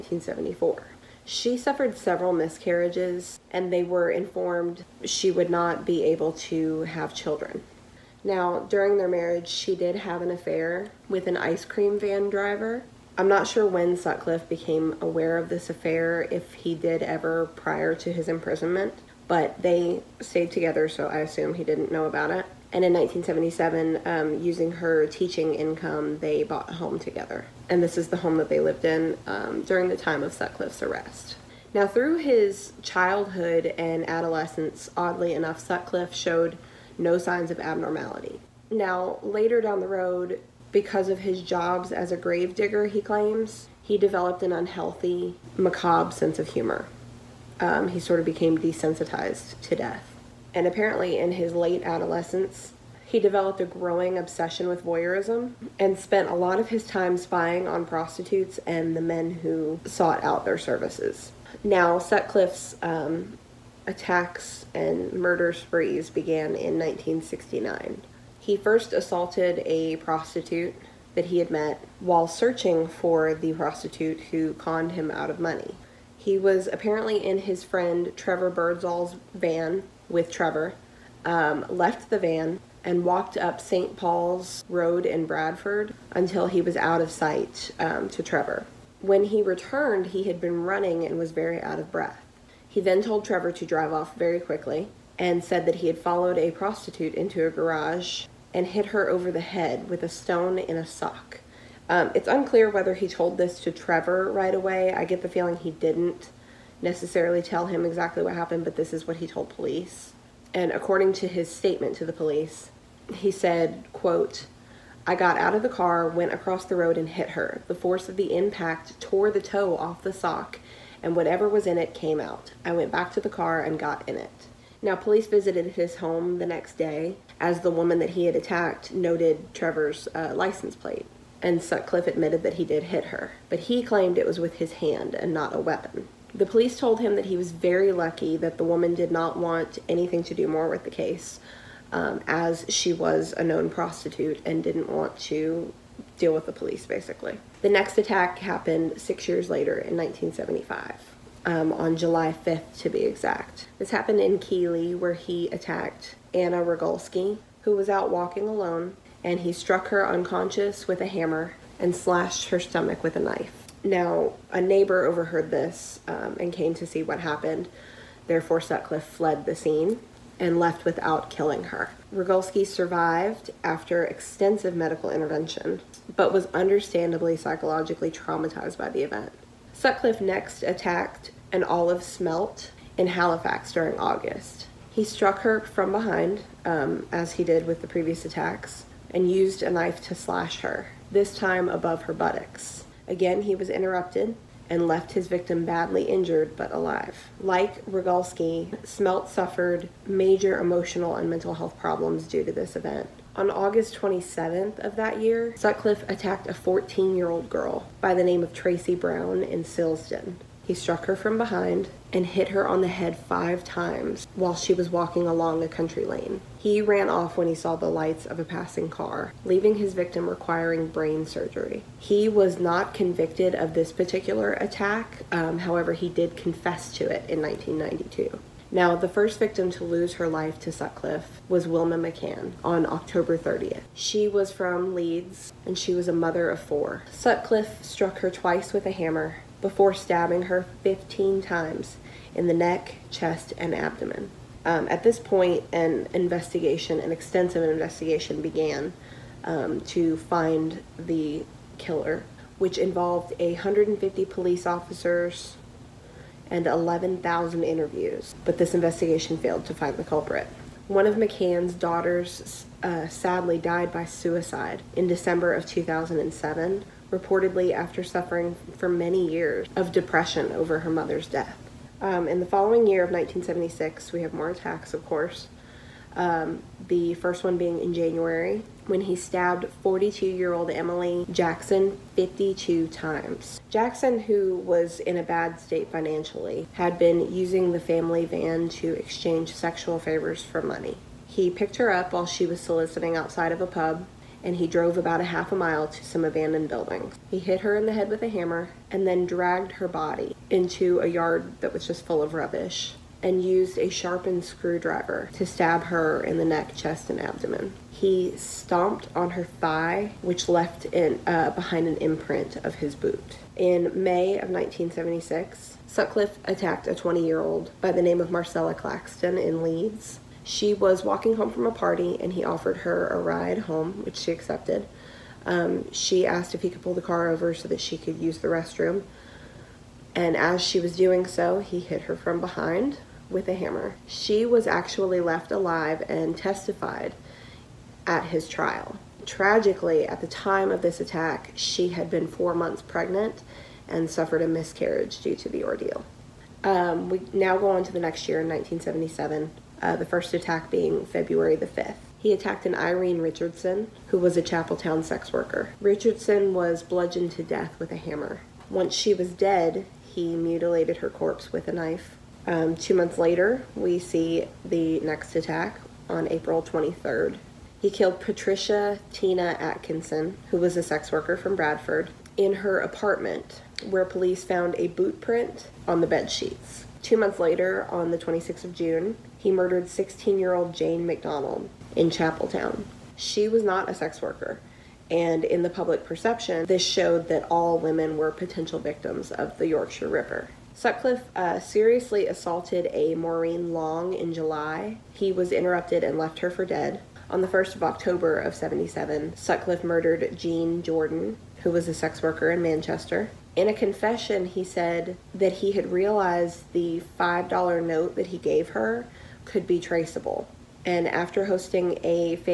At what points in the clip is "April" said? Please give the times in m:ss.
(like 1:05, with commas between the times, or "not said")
6:06.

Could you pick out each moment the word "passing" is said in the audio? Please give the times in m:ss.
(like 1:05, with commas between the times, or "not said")
3:38.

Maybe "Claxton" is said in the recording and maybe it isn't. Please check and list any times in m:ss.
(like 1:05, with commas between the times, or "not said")
5:18.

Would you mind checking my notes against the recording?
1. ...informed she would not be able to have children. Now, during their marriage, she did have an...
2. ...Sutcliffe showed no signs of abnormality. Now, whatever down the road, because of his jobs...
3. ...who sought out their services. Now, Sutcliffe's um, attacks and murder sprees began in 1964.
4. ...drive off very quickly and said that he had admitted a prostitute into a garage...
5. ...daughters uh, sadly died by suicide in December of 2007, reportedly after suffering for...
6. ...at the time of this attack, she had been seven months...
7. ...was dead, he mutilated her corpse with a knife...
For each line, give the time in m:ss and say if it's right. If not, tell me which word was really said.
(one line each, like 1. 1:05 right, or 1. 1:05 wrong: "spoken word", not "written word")
1. 0:04 right
2. 0:35 wrong: "later", not "whatever"
3. 0:59 wrong: "1969", not "1964"
4. 1:33 wrong: "followed", not "admitted"
5. 4:21 right
6. 5:40 wrong: "four", not "seven"
7. 5:59 right.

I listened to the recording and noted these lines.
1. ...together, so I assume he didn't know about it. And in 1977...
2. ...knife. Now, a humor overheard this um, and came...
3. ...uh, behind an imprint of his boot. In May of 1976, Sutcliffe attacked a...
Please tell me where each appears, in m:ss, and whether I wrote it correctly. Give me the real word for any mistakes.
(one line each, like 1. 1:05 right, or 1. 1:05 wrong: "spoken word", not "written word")
1. 0:20 right
2. 2:43 wrong: "neighbor", not "humor"
3. 5:11 right.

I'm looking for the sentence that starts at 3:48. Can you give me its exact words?
Now, the first victim to lose her life to Sutcliffe was Wilma McCann on October 30th.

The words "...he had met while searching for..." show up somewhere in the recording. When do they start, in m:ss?
1:11.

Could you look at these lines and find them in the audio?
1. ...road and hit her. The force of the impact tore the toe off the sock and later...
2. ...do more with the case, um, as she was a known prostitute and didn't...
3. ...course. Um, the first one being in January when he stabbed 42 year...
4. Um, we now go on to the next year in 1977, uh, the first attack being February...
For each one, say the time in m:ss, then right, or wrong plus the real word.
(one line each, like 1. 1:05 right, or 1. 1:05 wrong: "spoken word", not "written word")
1. 1:56 wrong: "whatever", not "later"
2. 2:20 right
3. 4:35 right
4. 5:46 right.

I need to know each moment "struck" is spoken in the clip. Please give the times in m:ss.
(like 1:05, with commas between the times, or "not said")
2:39, 3:05, 3:30, 3:57.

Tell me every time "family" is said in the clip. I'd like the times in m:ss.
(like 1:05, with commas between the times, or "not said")
4:47.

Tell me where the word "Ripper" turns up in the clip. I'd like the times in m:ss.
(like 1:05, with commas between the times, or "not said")
6:30.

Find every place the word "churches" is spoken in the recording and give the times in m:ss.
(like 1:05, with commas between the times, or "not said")
not said.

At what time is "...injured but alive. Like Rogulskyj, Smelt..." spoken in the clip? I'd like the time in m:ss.
3:16.